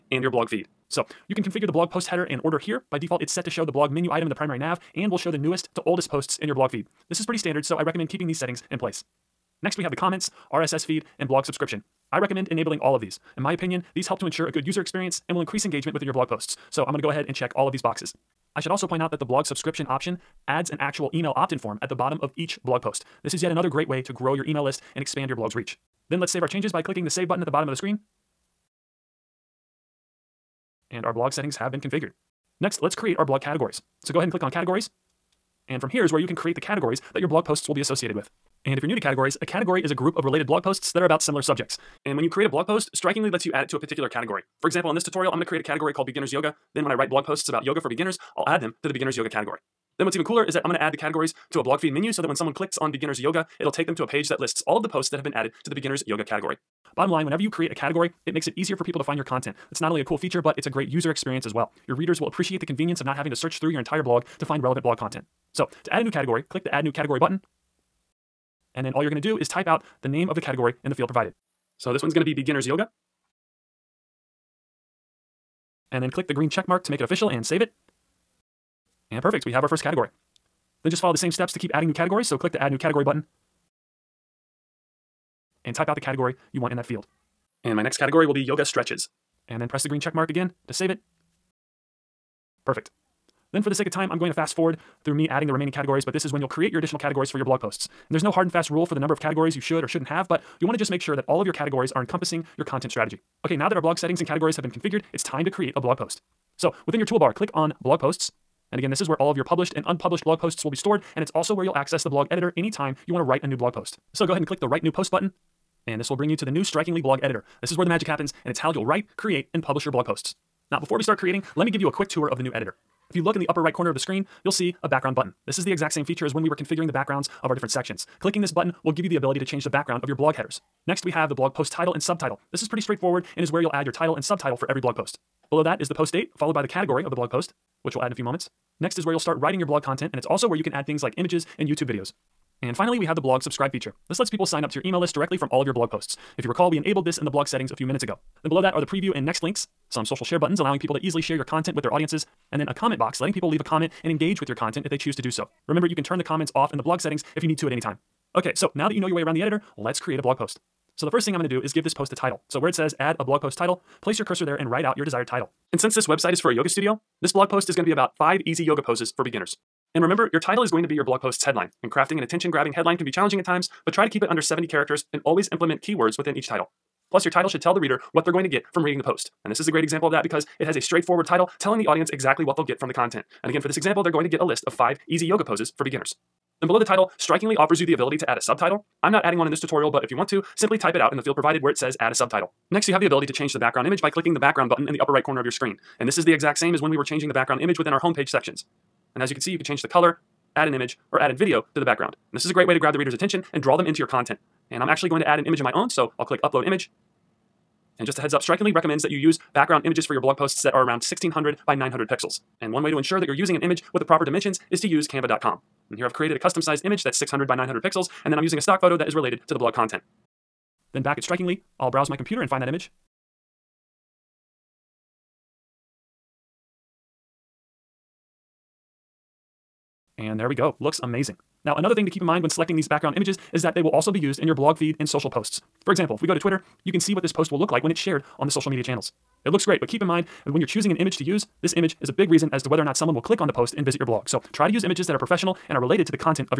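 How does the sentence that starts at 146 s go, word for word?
If you recall, we enabled this in the blog settings a few minutes ago.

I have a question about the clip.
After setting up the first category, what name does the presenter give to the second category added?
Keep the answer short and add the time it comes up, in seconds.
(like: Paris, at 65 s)
Yoga Stretches, at 88 s.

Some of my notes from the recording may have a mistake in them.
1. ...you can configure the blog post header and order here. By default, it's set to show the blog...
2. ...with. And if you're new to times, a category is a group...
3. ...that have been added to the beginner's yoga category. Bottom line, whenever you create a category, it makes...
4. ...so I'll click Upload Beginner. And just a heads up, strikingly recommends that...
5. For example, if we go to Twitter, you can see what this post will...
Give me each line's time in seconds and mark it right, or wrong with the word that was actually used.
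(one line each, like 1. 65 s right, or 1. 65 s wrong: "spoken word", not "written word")
1. 1 s right
2. 38 s wrong: "categories", not "times"
3. 55 s right
4. 205 s wrong: "Image", not "Beginner"
5. 235 s right.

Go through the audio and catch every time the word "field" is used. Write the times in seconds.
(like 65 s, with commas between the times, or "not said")
70 s, 86 s, 191 s.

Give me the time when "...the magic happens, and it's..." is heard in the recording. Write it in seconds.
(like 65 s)
117 s.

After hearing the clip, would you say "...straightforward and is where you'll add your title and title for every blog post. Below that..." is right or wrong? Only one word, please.
wrong.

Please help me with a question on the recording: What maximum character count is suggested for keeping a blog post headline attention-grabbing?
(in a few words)
70.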